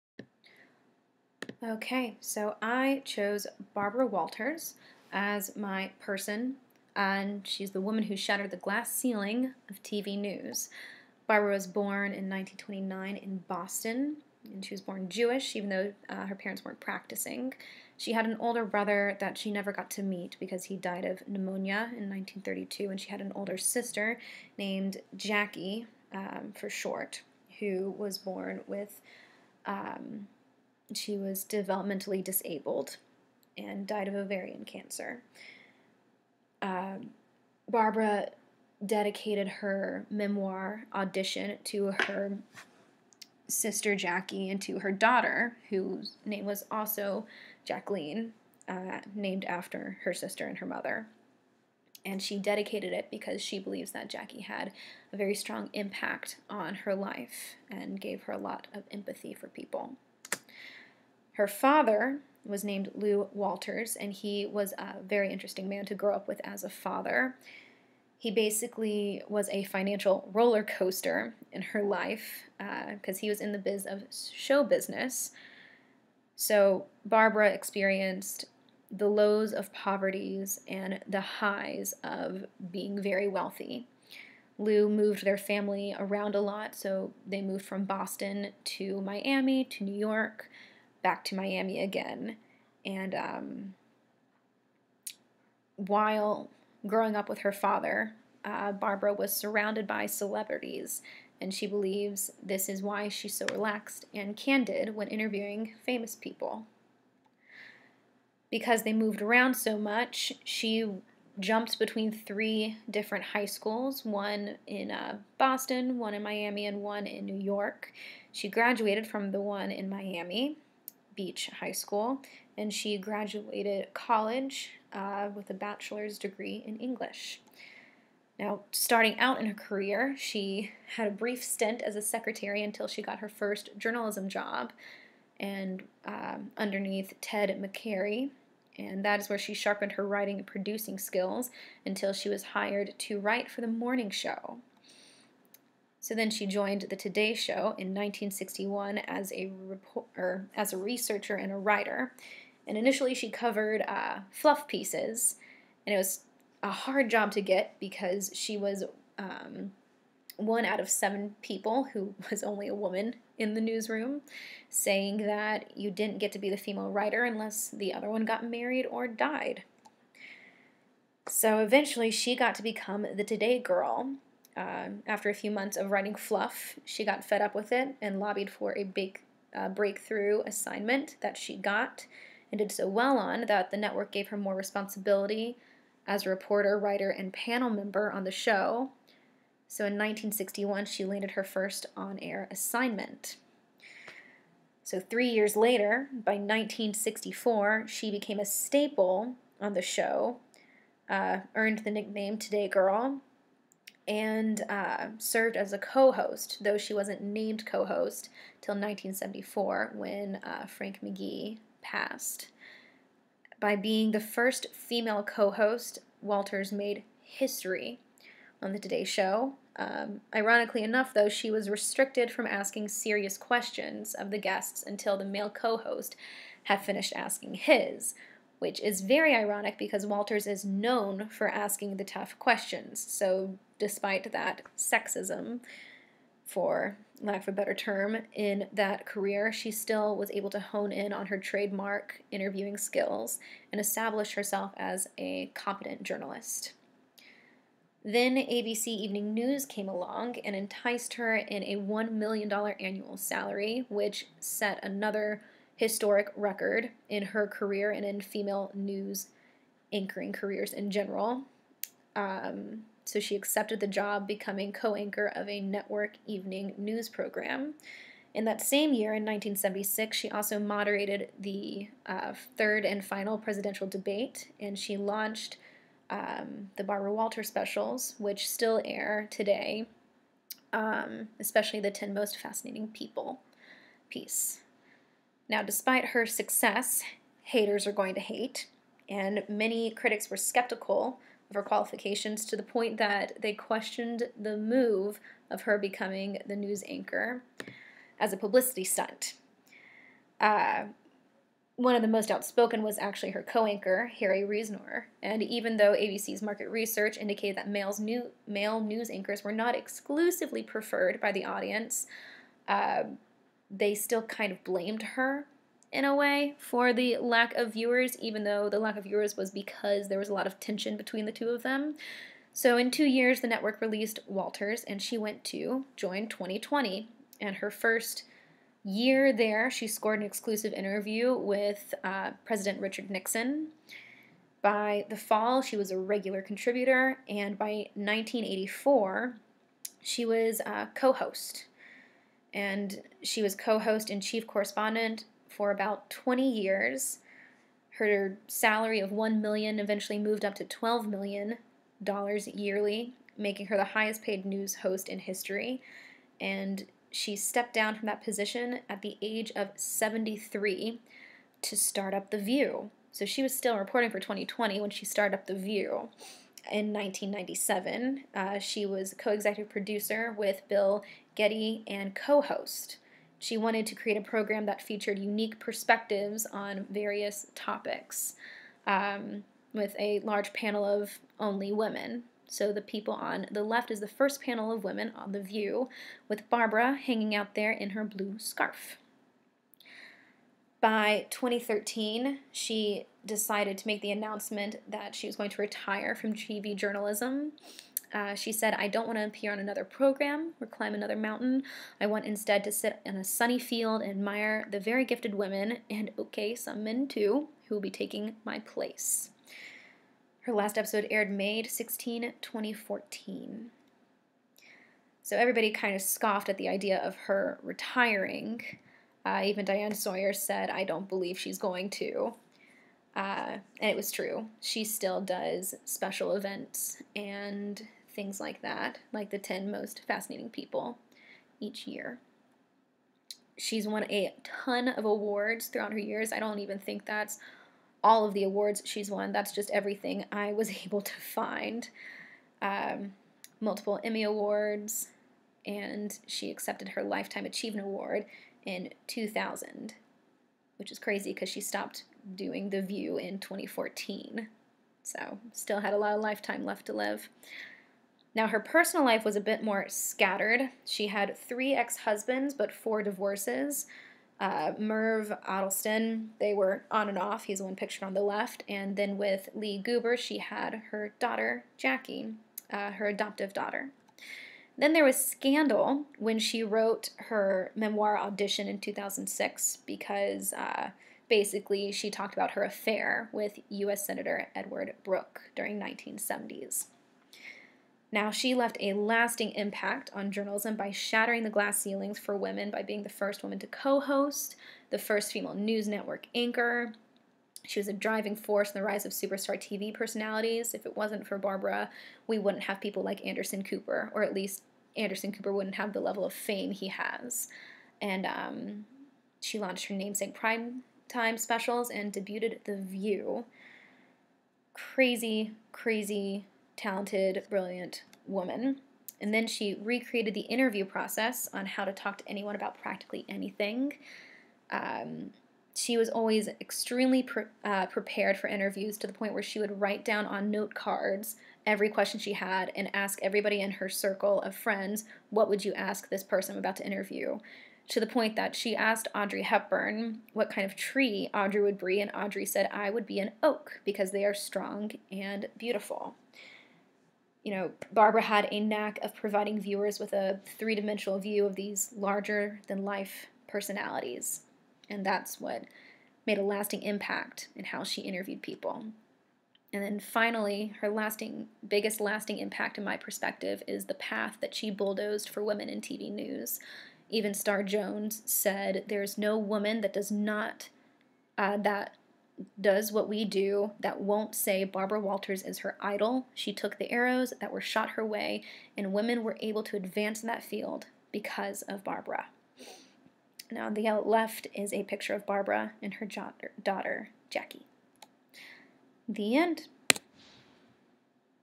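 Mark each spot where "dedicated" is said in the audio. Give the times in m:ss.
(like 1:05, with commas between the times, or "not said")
0:38, 0:52.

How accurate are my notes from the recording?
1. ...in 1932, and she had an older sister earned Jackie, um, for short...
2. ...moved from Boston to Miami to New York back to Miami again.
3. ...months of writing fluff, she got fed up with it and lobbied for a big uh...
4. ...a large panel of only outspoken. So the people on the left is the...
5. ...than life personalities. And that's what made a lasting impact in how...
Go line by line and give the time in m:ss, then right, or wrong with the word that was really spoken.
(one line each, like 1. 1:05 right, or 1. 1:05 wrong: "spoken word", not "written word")
1. 0:21 wrong: "named", not "earned"
2. 1:27 right
3. 2:55 right
4. 6:19 wrong: "women", not "outspoken"
5. 9:12 right.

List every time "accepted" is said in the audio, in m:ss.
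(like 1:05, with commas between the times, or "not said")
4:23, 7:26.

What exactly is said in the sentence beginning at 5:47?
Her salary of $1 million eventually moved up to $12 million yearly, making her the highest paid news host in history.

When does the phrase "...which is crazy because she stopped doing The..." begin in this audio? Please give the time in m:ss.
7:30.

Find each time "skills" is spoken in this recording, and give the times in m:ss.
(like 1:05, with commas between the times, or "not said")
2:20, 4:02.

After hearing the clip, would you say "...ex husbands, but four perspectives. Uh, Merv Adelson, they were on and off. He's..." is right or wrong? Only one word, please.
wrong.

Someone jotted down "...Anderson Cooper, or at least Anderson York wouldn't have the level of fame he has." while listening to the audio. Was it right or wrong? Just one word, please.
wrong.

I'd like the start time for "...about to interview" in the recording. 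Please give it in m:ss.
8:56.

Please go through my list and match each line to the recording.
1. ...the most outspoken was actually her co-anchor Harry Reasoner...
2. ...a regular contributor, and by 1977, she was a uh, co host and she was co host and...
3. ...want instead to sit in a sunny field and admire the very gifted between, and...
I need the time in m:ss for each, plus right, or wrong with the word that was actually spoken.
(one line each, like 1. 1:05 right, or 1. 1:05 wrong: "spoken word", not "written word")
1. 5:02 right
2. 5:35 wrong: "1984", not "1977"
3. 6:42 wrong: "women", not "between".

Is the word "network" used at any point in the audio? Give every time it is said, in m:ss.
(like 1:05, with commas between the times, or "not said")
3:03, 4:25, 5:23, 8:15.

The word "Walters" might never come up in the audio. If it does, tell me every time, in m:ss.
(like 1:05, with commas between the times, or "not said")
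0:04, 1:03, 3:36, 3:50, 4:37, 5:24, 9:34.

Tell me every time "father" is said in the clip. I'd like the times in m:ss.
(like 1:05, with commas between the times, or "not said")
1:01, 1:06, 1:37.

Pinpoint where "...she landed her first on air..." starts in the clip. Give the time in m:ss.
3:10.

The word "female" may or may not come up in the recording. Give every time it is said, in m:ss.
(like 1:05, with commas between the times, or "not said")
2:46, 3:34, 4:18, 8:15.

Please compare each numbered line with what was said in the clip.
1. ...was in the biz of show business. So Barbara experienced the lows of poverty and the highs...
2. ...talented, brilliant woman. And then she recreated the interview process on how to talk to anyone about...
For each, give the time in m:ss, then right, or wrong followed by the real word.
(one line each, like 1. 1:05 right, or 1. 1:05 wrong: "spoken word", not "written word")
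1. 1:13 right
2. 8:36 right.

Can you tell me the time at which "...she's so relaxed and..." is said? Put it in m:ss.
1:43.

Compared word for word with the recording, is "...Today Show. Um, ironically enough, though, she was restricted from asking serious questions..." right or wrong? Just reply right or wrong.
right.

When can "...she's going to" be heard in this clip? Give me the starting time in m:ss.
7:01.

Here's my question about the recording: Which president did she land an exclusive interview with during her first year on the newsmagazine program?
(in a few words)
Richard Nixon.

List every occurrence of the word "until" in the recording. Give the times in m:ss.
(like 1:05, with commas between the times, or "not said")
2:12, 2:21, 3:44.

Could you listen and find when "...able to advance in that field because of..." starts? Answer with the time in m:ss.
9:39.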